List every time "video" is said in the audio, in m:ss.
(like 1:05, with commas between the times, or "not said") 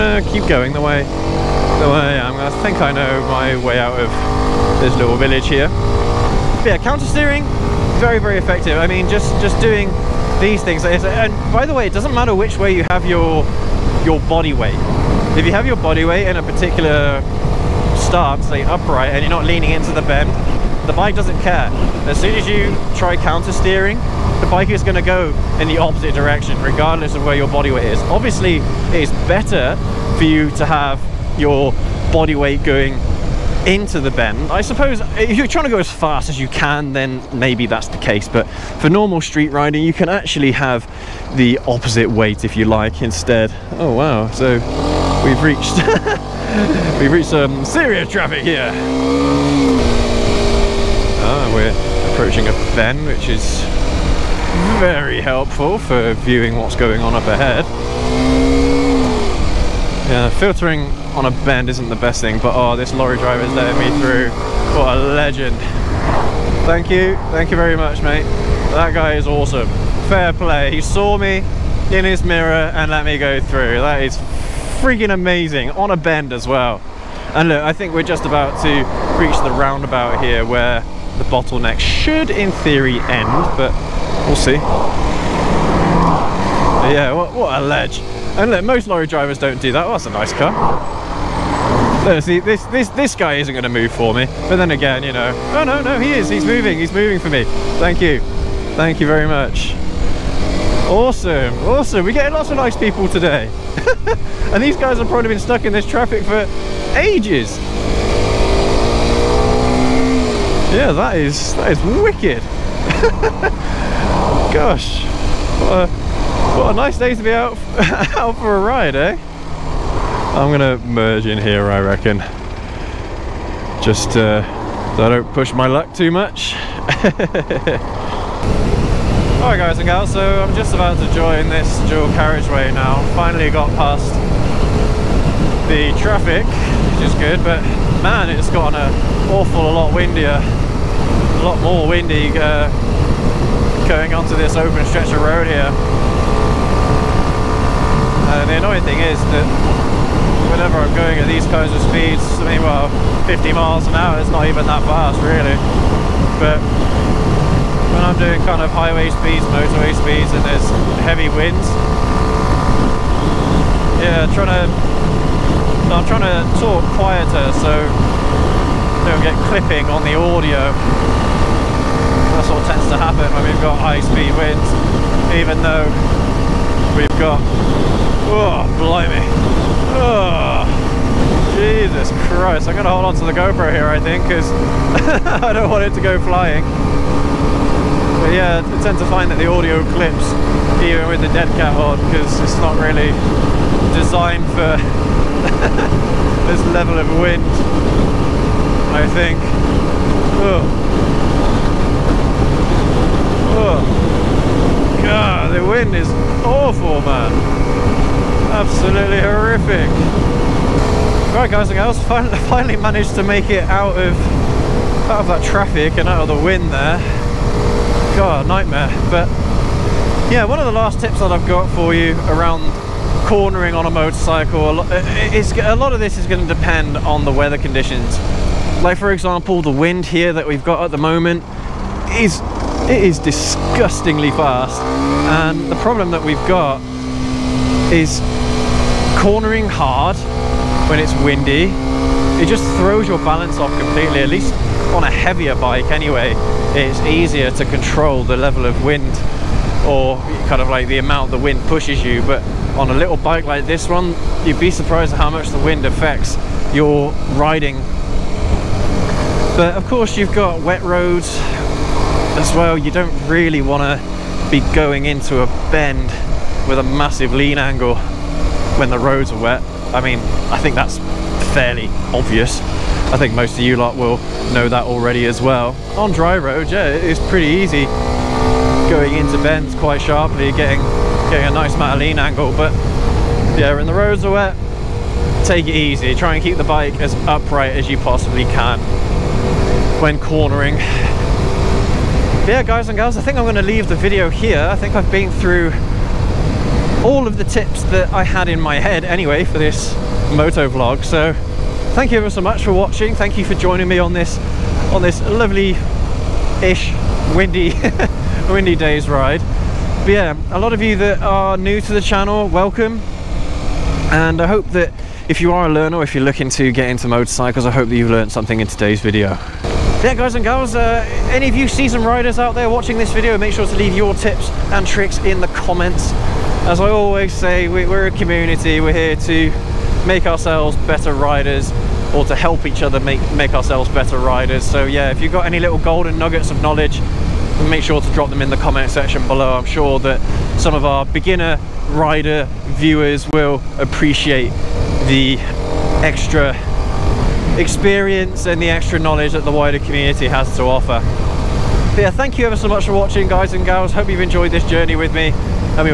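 4:53, 5:19, 5:23.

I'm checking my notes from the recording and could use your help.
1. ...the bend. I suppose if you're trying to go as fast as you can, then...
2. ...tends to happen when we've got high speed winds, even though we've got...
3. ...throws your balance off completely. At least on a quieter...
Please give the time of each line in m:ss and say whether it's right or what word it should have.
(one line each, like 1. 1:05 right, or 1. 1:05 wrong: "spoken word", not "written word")
1. 0:34 right
2. 2:52 right
3. 4:02 wrong: "heavier", not "quieter".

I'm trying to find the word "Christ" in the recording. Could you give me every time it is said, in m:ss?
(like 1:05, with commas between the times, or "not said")
3:02.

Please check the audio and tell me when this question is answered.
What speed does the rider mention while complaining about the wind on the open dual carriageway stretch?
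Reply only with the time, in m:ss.
2:33.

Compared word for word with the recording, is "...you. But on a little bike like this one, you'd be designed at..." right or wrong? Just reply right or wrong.
wrong.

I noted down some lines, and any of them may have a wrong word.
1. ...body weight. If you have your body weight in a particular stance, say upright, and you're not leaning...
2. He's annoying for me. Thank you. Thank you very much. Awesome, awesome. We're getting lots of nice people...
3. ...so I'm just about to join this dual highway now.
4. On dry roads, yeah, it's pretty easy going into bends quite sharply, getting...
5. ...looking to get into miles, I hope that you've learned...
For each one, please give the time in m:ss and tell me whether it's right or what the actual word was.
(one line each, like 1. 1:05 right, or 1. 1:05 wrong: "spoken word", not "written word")
1. 0:14 right
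2. 1:36 wrong: "moving", not "annoying"
3. 2:10 wrong: "carriageway", not "highway"
4. 4:35 right
5. 5:16 wrong: "motorcycles", not "miles".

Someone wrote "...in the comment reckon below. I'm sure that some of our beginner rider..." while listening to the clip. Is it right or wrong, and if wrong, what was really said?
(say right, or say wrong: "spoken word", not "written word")
wrong: "section", not "reckon".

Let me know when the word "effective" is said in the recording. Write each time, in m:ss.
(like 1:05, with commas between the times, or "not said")
0:08.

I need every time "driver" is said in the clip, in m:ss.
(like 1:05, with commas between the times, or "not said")
1:03, 1:29.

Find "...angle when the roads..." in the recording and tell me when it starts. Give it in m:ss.
4:27.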